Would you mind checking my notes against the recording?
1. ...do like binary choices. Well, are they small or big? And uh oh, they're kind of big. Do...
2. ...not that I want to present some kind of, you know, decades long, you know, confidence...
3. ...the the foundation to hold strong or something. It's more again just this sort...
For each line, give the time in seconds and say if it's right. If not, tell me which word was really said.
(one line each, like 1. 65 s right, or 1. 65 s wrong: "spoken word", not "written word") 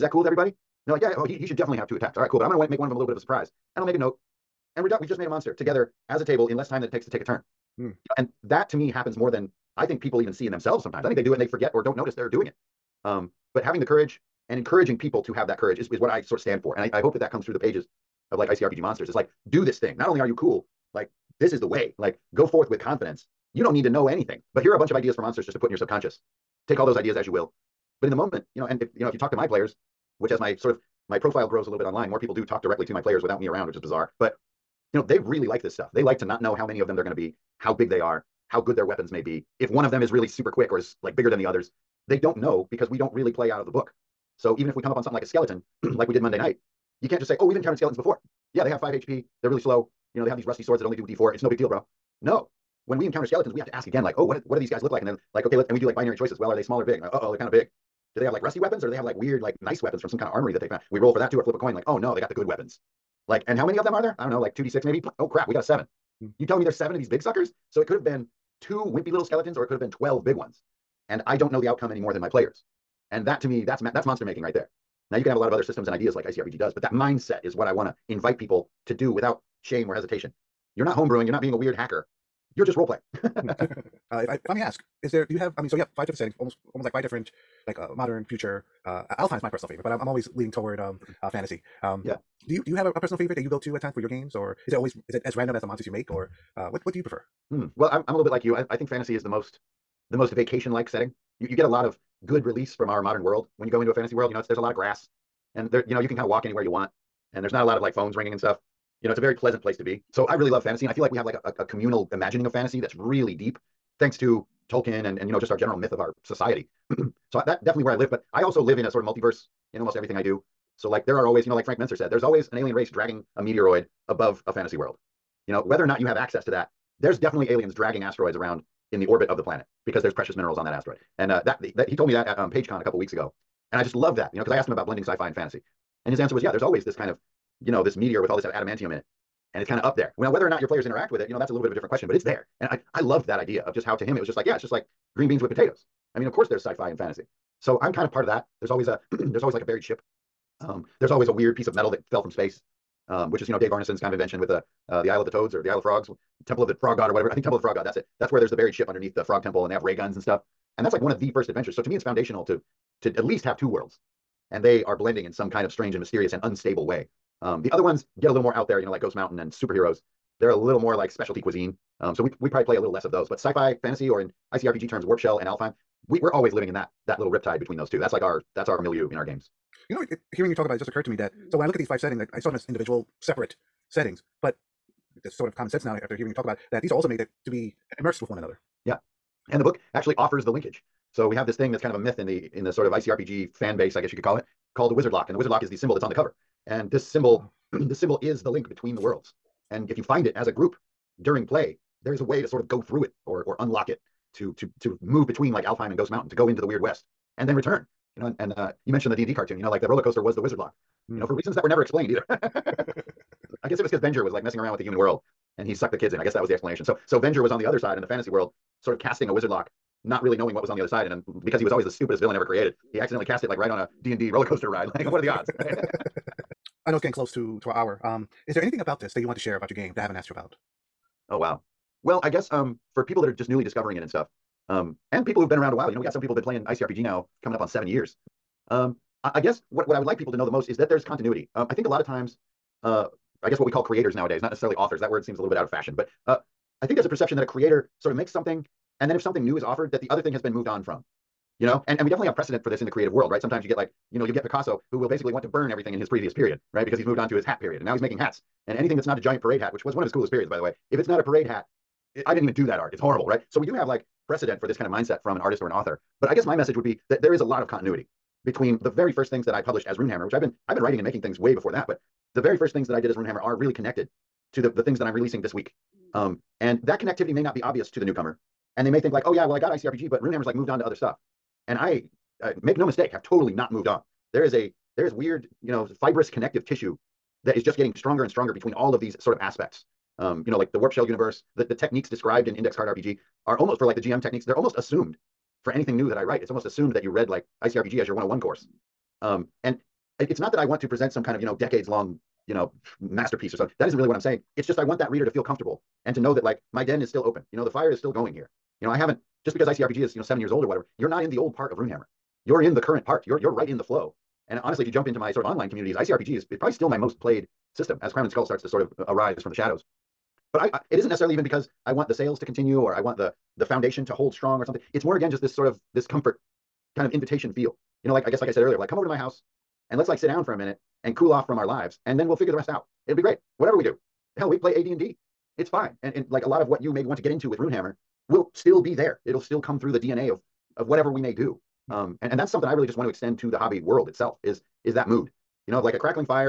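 1. 55 s right
2. 300 s wrong: "masterpiece", not "confidence"
3. 323 s right.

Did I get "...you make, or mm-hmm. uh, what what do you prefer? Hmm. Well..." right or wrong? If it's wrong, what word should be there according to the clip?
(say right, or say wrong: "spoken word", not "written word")
right.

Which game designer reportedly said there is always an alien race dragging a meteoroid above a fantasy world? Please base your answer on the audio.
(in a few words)
Frank Menzer.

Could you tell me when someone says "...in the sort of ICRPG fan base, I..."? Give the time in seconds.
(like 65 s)
192 s.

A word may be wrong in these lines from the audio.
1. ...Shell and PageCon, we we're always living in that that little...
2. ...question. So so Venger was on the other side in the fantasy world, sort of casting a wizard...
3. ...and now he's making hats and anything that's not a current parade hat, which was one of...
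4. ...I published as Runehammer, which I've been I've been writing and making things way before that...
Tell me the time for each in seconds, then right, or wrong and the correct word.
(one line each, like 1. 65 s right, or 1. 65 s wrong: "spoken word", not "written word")
1. 175 s wrong: "Alfheim", not "PageCon"
2. 216 s wrong: "explanation", not "question"
3. 257 s wrong: "giant", not "current"
4. 269 s right.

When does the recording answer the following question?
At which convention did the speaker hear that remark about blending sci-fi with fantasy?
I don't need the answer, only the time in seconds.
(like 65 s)
132 s.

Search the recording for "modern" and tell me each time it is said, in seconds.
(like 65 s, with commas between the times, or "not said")
87 s, 103 s.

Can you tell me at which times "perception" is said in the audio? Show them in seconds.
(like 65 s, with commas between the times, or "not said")
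247 s.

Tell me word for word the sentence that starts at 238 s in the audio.
Um, I, I guess what what I would like people to know the most is that there's continuity.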